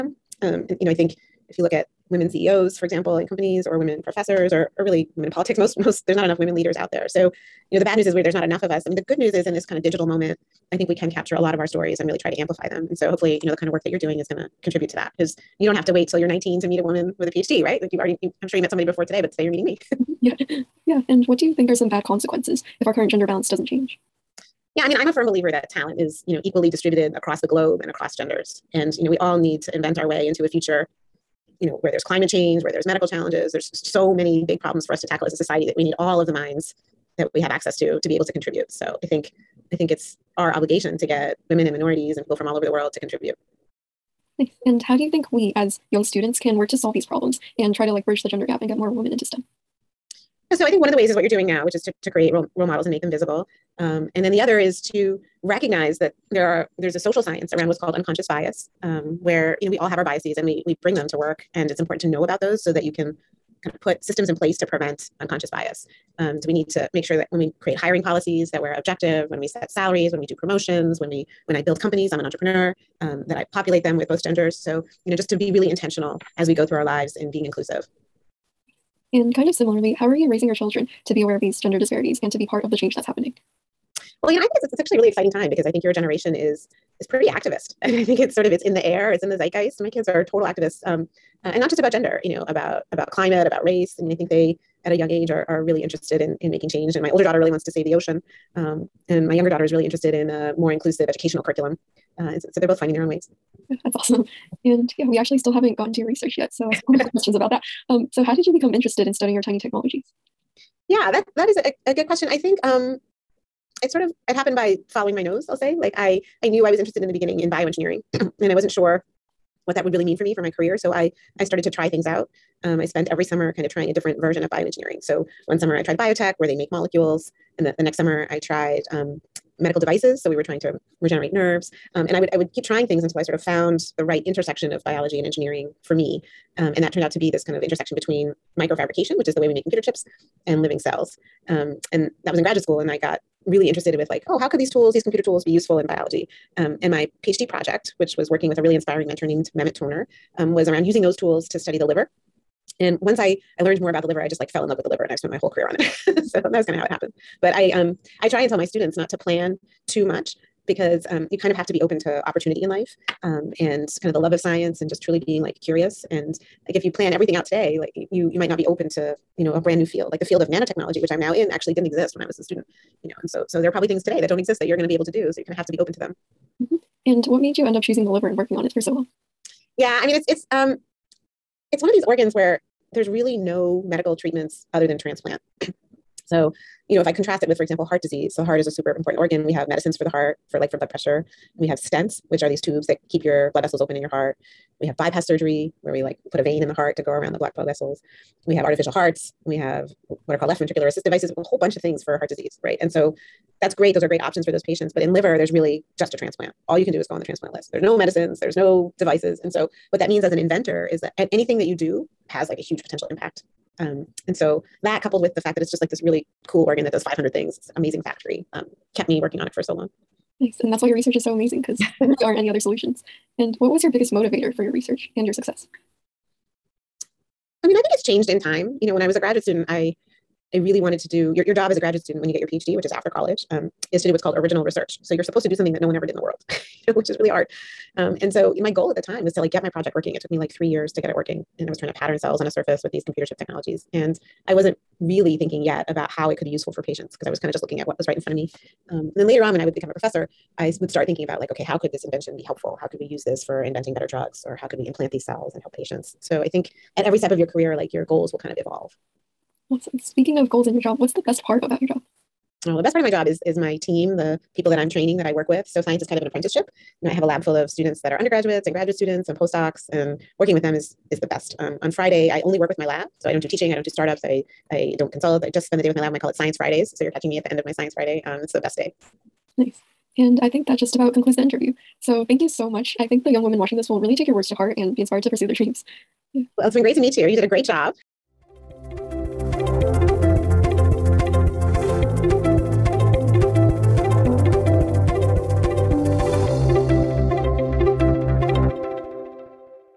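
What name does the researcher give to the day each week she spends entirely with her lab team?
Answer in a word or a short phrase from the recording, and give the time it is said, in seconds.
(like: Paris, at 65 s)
Science Fridays, at 276 s.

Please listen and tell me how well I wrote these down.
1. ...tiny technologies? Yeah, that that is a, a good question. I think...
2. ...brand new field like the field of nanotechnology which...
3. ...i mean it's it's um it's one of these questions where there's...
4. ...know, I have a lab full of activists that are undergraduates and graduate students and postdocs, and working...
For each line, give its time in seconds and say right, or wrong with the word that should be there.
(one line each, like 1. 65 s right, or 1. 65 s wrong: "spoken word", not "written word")
1. 109 s right
2. 169 s right
3. 180 s wrong: "organs", not "questions"
4. 267 s wrong: "students", not "activists".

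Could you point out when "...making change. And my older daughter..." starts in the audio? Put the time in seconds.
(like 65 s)
96 s.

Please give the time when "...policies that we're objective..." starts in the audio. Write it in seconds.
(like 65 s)
68 s.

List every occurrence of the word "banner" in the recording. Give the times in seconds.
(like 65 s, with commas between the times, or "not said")
not said.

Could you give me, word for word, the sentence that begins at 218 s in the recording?
Um, kept me working on it for so long.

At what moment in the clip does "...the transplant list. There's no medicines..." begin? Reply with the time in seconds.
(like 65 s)
207 s.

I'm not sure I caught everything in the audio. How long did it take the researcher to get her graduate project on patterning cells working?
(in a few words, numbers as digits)
three years.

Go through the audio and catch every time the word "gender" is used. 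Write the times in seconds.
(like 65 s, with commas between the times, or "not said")
23 s, 28 s, 48 s, 74 s, 81 s, 91 s.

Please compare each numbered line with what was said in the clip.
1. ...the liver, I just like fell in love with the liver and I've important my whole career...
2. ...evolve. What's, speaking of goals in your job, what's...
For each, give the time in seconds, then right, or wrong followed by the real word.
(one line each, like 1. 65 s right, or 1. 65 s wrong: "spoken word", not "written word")
1. 154 s wrong: "spent", not "important"
2. 258 s right.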